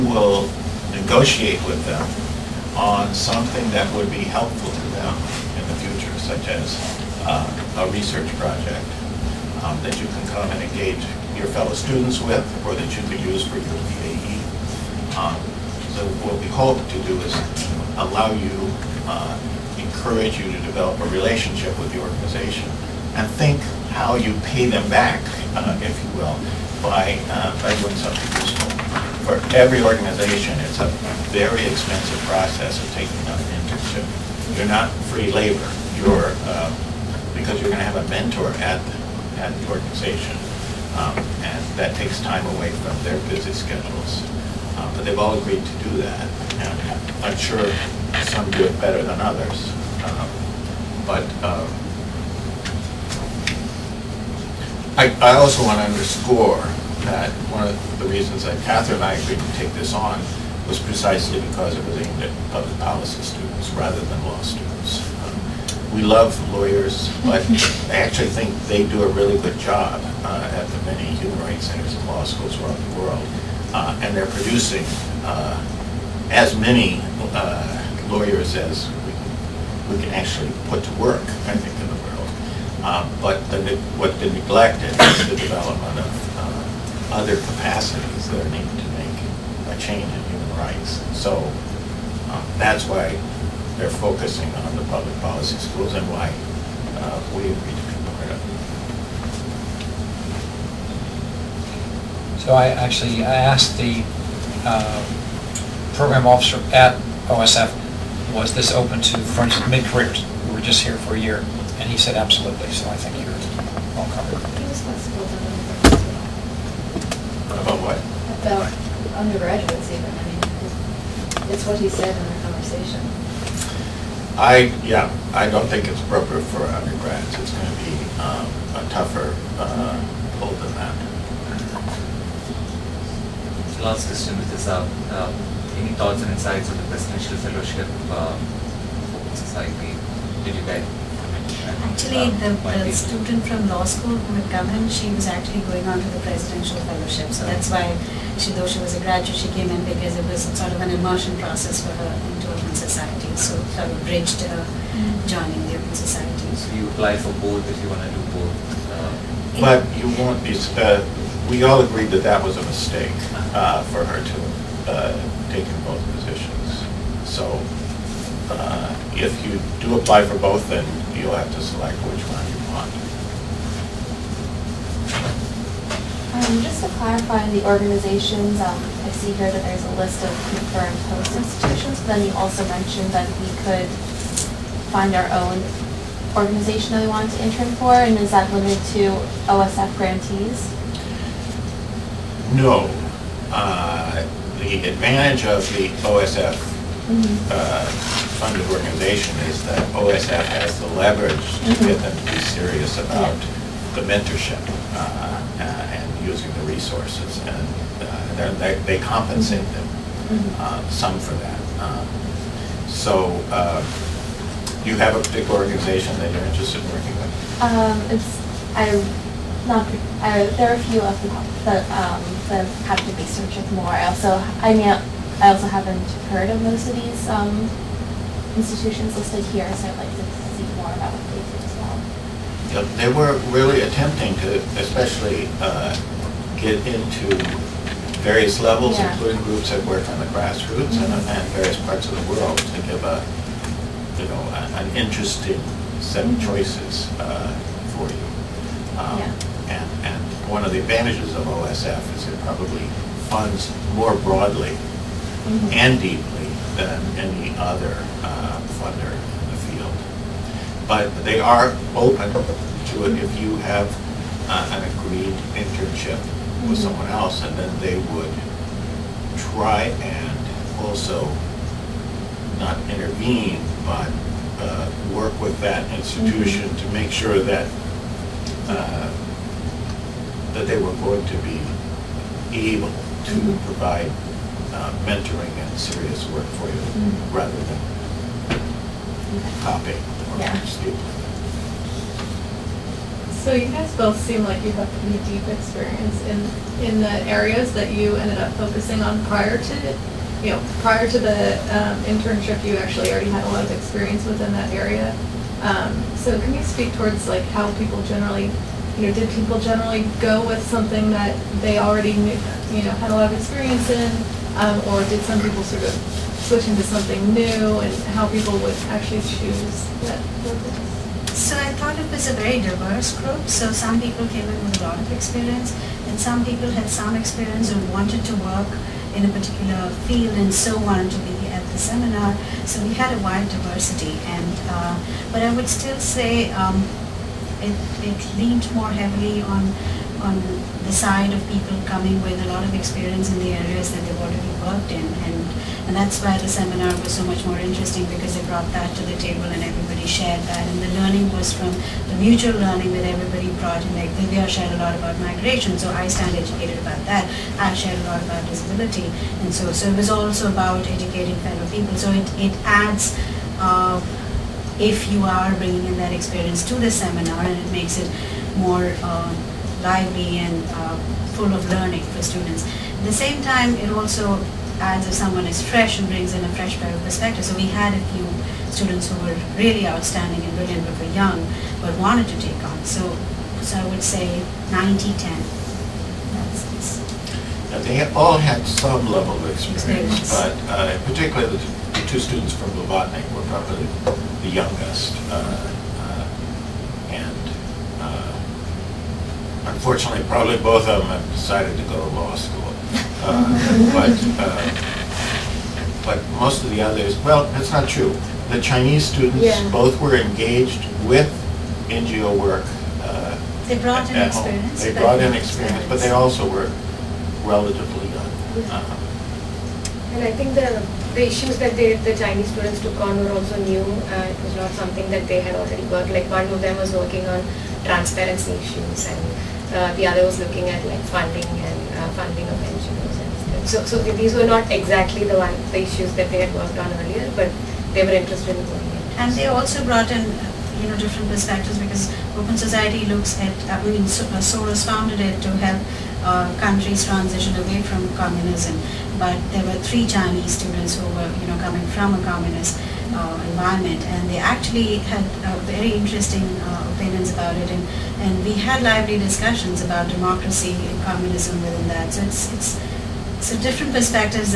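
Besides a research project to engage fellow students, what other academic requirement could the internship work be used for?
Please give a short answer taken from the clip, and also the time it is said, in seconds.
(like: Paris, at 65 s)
PAE, at 14 s.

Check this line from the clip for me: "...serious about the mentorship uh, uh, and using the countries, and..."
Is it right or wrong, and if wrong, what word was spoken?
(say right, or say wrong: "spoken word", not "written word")
wrong: "resources", not "countries".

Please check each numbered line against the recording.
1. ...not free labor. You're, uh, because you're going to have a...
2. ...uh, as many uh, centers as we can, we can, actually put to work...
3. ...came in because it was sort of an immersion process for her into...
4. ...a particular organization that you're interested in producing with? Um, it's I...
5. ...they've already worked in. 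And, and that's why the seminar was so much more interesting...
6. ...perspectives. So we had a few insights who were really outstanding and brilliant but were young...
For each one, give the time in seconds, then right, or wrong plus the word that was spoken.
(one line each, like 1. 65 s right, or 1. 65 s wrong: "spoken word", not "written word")
1. 34 s right
2. 75 s wrong: "lawyers", not "centers"
3. 149 s right
4. 215 s wrong: "working", not "producing"
5. 344 s right
6. 377 s wrong: "students", not "insights".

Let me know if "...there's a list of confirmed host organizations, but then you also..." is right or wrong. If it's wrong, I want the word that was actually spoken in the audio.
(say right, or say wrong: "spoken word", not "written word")
wrong: "institutions", not "organizations".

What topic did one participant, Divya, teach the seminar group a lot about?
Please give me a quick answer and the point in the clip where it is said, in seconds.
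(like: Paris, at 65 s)
Migration, at 355 s.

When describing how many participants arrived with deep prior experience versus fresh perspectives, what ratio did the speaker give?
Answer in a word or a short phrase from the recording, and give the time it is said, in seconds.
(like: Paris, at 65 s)
90-10, at 384 s.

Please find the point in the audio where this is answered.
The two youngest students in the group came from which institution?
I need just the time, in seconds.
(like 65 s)
392 s.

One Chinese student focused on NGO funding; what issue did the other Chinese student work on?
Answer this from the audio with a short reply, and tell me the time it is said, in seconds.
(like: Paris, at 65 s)
Transparency, at 427 s.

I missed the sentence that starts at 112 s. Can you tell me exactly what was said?
So I think you're all covered.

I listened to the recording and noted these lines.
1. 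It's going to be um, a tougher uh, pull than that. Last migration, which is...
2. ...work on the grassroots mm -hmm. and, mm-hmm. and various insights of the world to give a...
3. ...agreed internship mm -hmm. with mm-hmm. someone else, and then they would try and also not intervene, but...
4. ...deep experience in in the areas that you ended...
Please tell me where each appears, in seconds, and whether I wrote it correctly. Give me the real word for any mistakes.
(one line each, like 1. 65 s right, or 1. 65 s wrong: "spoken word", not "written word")
1. 127 s wrong: "question", not "migration"
2. 239 s wrong: "parts", not "insights"
3. 264 s right
4. 295 s right.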